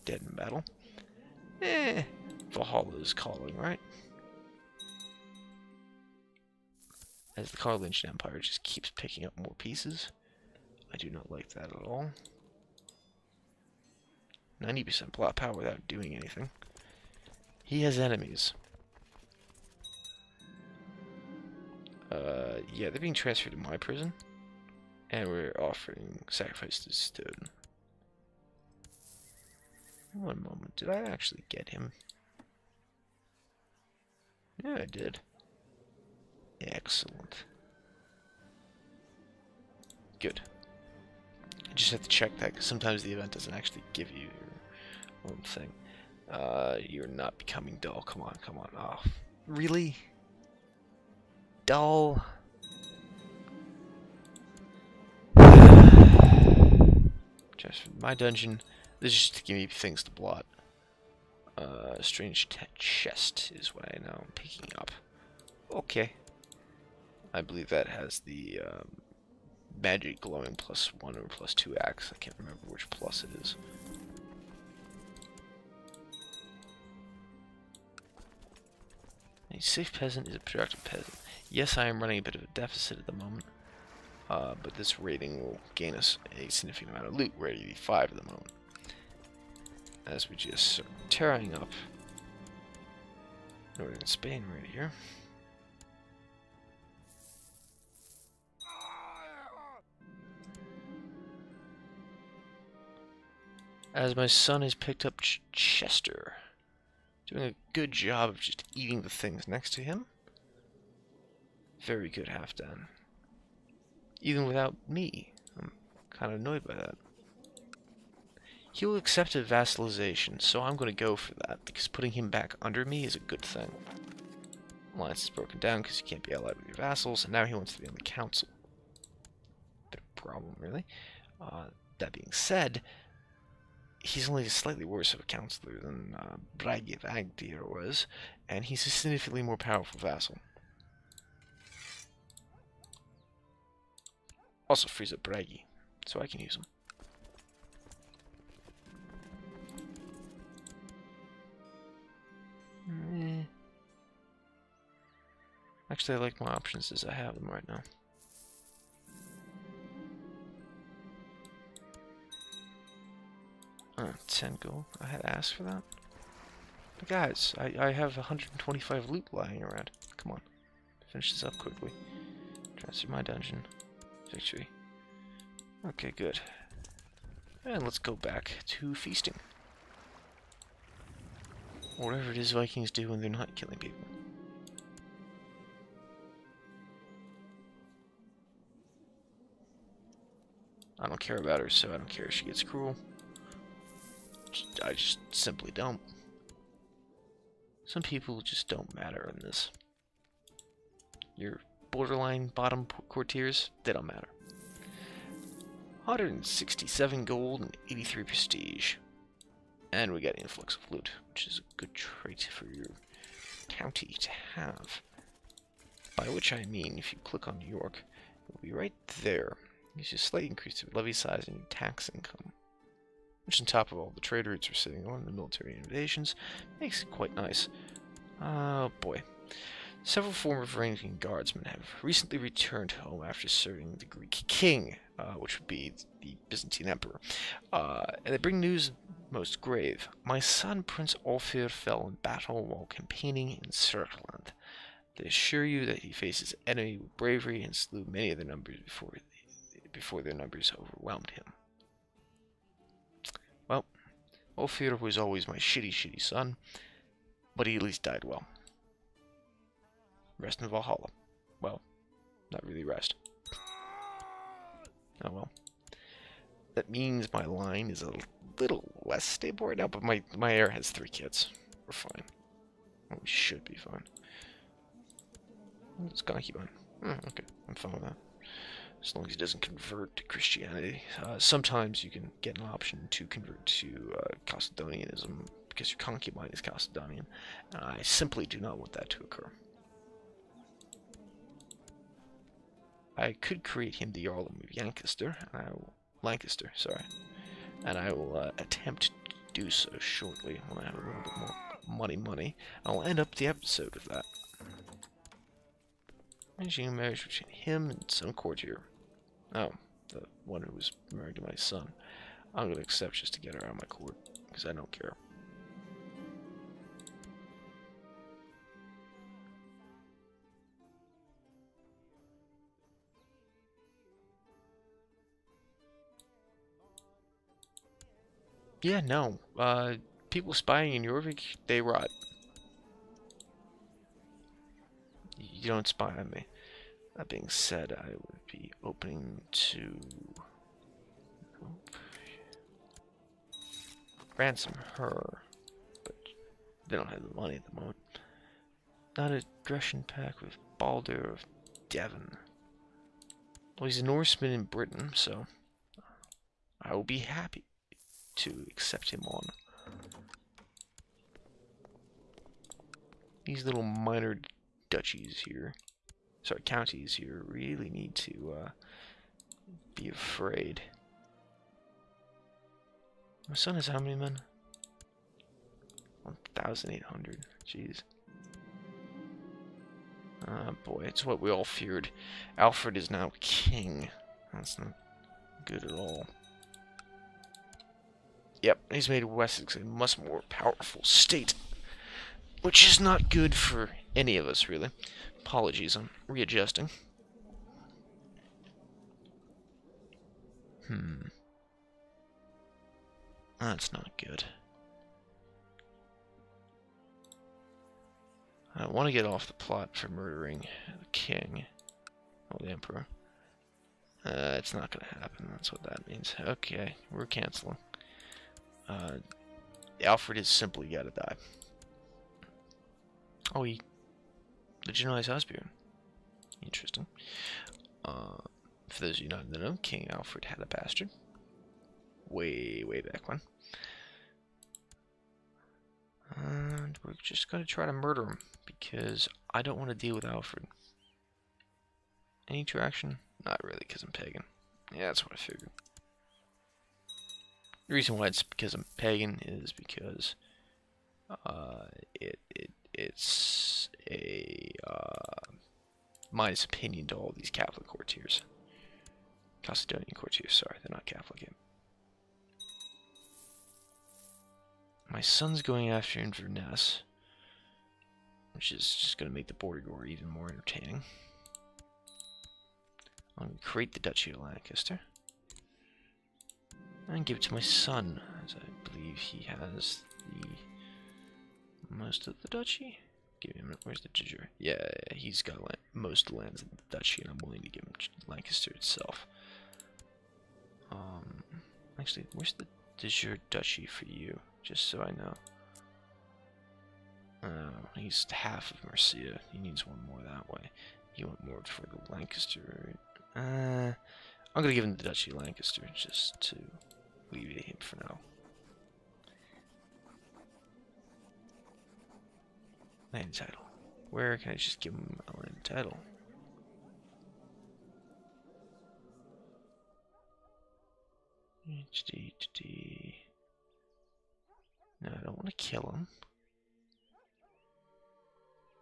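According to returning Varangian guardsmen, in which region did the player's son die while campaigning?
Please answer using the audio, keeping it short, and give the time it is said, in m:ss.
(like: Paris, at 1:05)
Serkland, at 4:03.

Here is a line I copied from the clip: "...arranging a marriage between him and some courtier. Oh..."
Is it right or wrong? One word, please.
right.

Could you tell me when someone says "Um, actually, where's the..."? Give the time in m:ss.
8:10.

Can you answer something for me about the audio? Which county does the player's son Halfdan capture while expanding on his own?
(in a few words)
Chester.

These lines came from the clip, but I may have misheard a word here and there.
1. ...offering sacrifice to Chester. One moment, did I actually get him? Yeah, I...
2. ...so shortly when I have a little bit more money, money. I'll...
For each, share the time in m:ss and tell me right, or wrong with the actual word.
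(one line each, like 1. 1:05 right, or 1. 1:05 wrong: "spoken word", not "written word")
1. 0:25 wrong: "Stone", not "Chester"
2. 4:59 right.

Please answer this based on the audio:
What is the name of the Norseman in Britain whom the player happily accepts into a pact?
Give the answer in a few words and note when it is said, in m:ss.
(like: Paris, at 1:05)
Balder of Devon, at 5:50.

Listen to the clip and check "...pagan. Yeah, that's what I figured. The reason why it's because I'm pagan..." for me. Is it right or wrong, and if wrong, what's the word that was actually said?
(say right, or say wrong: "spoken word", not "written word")
right.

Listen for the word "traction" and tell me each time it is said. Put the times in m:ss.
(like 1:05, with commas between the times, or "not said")
7:22.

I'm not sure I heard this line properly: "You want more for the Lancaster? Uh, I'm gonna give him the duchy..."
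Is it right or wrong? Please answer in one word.
right.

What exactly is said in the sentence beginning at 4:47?
I simply do not want that to occur.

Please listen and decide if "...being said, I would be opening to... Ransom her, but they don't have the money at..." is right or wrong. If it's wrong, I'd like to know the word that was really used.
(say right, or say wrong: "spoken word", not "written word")
right.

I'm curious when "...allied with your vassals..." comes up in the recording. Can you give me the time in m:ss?
2:06.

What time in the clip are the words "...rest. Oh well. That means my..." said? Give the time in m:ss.
4:22.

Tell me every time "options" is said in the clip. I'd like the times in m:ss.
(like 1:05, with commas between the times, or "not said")
2:36, 4:42.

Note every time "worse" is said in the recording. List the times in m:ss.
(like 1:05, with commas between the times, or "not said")
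2:14.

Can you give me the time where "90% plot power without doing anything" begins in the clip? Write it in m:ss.
0:14.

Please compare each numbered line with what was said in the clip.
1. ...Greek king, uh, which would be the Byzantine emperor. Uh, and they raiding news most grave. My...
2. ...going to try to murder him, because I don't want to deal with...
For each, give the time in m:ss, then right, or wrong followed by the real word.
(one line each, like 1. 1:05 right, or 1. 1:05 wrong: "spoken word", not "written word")
1. 3:54 wrong: "bring", not "raiding"
2. 7:17 right.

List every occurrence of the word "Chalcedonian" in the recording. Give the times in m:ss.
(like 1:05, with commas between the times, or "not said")
4:46, 7:39.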